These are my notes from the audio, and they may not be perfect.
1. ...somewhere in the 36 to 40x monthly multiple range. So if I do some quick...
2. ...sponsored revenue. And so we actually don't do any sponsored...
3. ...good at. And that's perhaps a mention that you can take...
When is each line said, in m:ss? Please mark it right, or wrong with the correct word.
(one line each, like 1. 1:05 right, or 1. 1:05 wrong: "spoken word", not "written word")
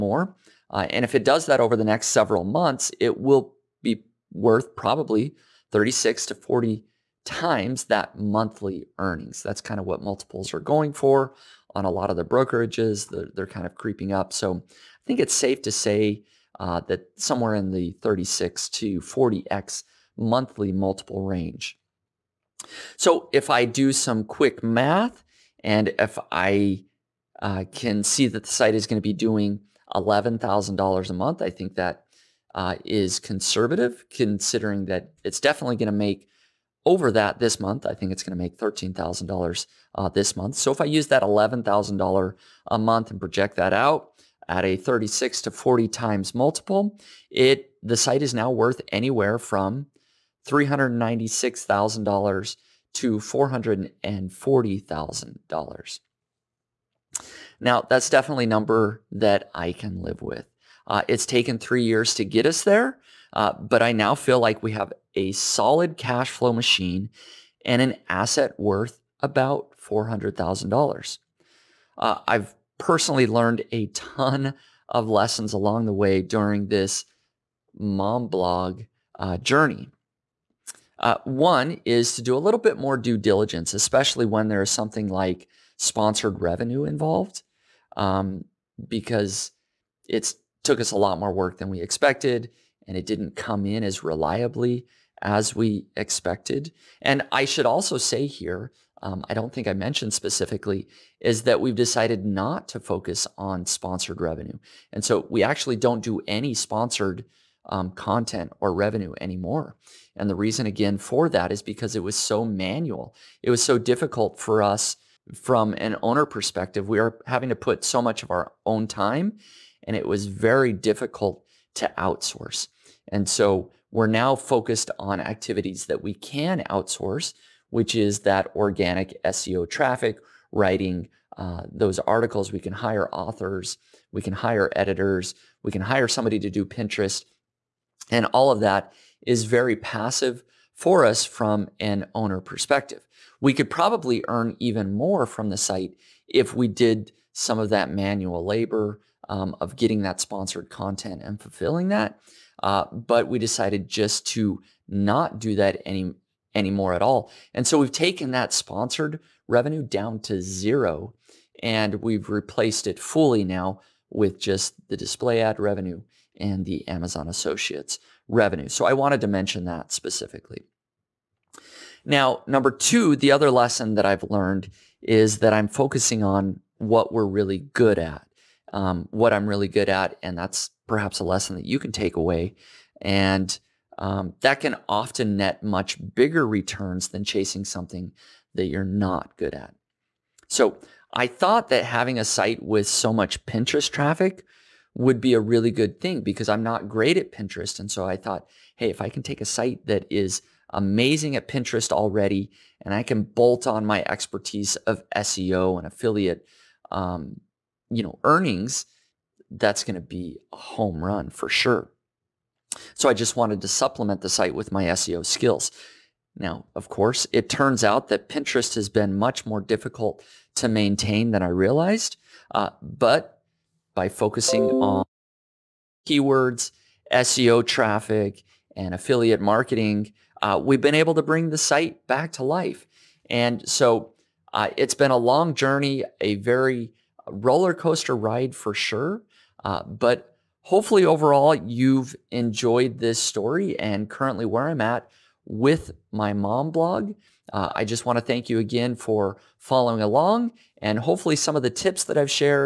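1. 0:17 right
2. 1:43 right
3. 2:59 wrong: "lesson", not "mention".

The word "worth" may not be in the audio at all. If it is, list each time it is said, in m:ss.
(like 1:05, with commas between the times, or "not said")
0:04, 0:48, 1:08.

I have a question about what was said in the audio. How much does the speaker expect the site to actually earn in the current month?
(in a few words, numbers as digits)
$13,000.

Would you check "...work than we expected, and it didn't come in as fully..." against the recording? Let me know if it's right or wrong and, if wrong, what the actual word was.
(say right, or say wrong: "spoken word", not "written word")
wrong: "reliably", not "fully".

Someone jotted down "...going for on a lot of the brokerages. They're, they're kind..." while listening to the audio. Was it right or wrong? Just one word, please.
right.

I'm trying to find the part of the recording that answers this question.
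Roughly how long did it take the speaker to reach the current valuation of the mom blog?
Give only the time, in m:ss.
1:01.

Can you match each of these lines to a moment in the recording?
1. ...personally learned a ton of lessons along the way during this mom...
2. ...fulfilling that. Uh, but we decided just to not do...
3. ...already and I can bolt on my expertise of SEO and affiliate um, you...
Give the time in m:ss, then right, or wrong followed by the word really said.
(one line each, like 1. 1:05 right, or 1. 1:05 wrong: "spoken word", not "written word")
1. 1:12 right
2. 2:31 right
3. 3:21 right.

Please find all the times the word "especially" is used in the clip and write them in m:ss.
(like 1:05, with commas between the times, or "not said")
1:23.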